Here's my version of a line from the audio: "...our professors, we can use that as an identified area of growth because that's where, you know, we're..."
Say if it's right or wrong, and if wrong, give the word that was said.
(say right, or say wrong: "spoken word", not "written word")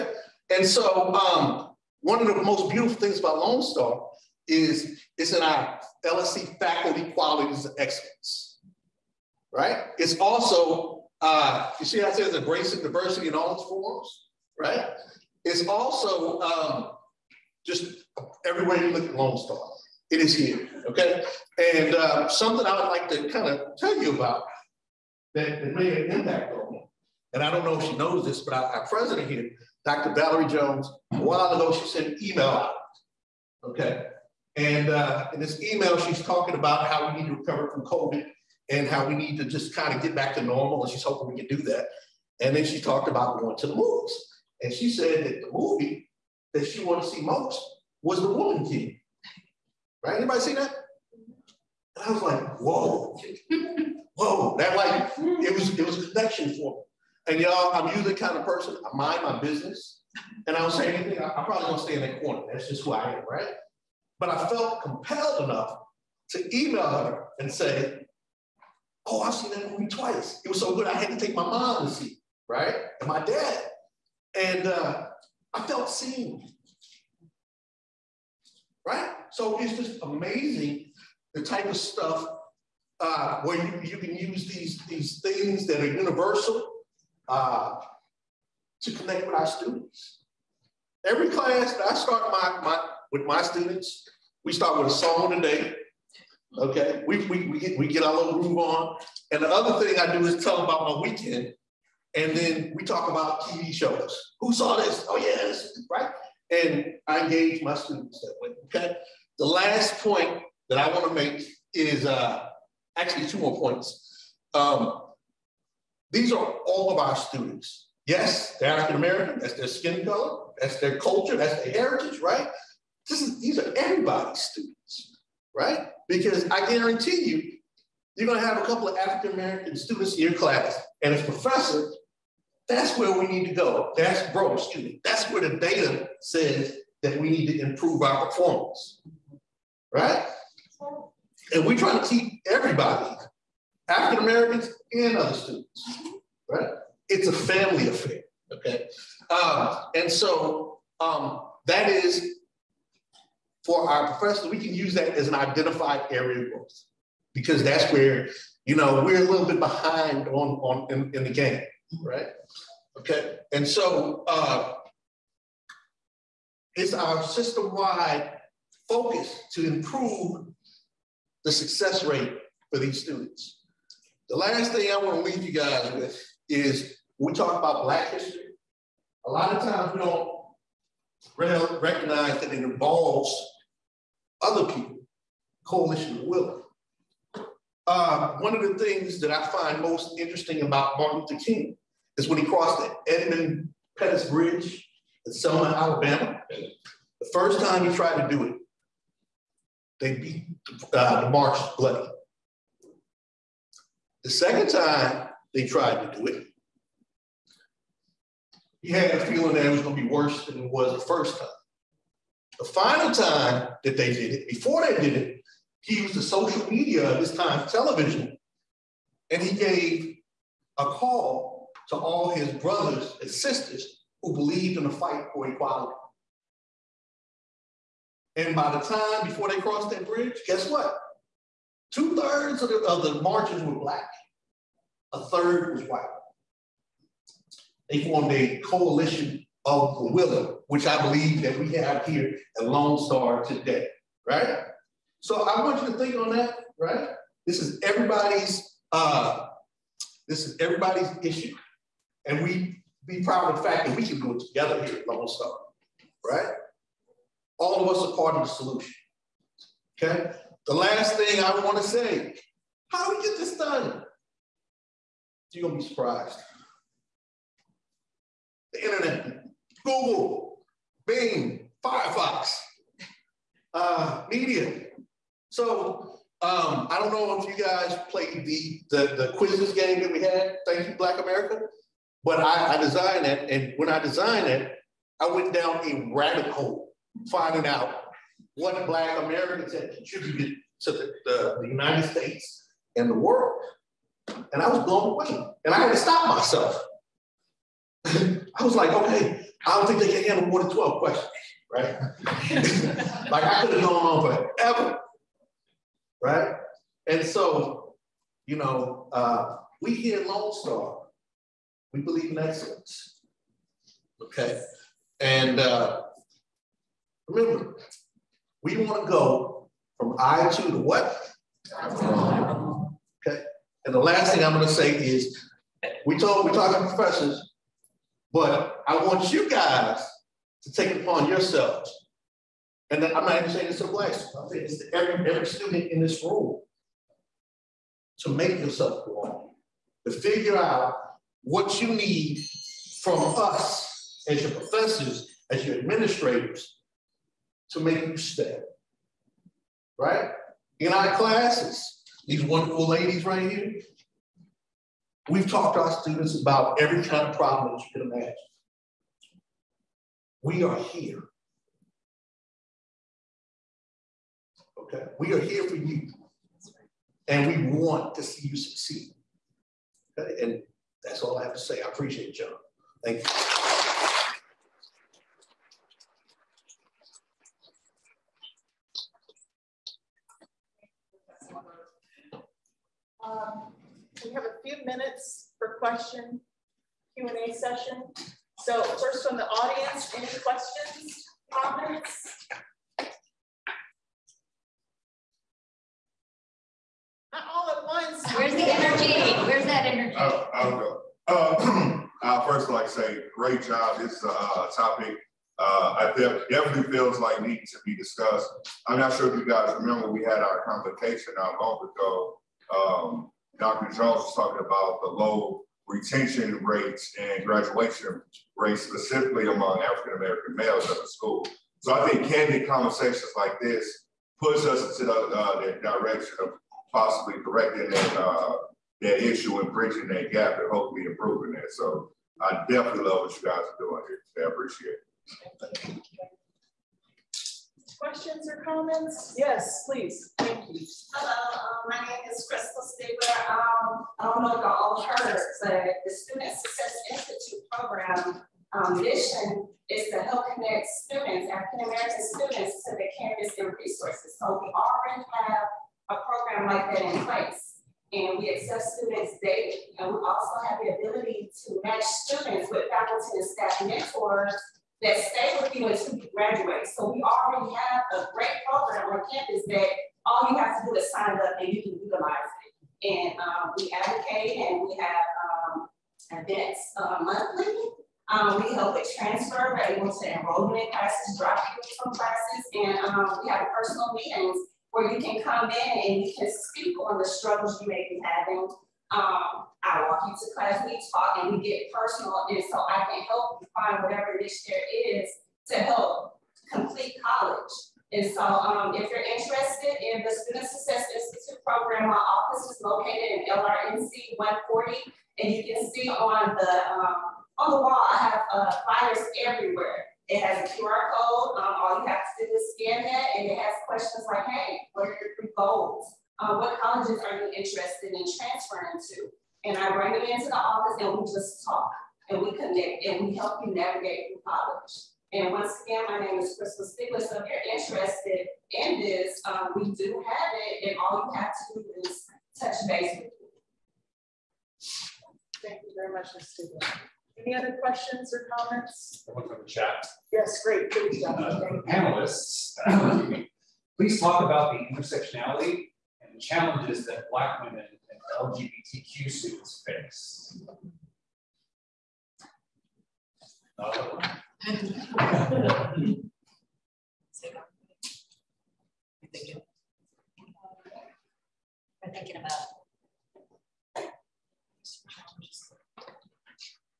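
right.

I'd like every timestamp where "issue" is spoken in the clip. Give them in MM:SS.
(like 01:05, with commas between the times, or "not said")
04:11, 07:09.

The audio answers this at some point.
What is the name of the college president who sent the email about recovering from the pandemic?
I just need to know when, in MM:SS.
00:29.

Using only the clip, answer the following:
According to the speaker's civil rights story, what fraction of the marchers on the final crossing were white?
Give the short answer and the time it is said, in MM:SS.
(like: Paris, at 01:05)
a third, at 03:55.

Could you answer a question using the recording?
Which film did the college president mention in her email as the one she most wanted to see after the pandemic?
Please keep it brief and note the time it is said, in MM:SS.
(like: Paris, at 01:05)
The Woman King, at 00:48.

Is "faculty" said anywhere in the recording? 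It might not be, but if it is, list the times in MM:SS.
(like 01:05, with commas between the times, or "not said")
00:06, 07:42.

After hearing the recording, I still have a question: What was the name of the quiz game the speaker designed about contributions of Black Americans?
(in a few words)
Thank You Black America.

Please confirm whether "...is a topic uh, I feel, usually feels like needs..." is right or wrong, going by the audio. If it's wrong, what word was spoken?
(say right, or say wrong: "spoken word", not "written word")
wrong: "definitely", not "usually".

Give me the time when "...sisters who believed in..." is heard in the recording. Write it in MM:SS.
03:43.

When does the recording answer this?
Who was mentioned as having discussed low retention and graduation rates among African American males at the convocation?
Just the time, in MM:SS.
06:53.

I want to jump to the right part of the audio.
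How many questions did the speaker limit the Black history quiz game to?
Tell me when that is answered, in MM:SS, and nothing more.
05:00.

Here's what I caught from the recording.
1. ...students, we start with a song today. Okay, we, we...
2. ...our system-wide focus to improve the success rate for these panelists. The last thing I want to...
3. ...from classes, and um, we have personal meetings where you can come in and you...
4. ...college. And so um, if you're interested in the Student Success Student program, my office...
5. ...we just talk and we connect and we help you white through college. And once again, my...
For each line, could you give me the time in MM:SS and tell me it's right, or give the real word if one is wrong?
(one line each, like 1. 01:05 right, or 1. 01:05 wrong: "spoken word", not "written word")
1. 01:33 right
2. 02:46 wrong: "students", not "panelists"
3. 08:02 right
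4. 08:17 wrong: "Institute", not "Student"
5. 08:41 wrong: "navigate", not "white".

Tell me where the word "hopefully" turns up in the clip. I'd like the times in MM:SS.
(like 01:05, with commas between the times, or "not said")
07:10.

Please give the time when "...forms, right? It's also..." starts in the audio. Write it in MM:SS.
00:13.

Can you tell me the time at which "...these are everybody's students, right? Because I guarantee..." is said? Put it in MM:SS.
02:03.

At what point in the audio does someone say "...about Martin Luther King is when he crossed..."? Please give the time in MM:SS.
03:10.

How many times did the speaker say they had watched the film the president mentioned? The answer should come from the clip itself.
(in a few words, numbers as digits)
2.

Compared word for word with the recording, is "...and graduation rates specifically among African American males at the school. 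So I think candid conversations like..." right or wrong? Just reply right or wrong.
right.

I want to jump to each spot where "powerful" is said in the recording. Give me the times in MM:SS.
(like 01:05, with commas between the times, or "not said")
not said.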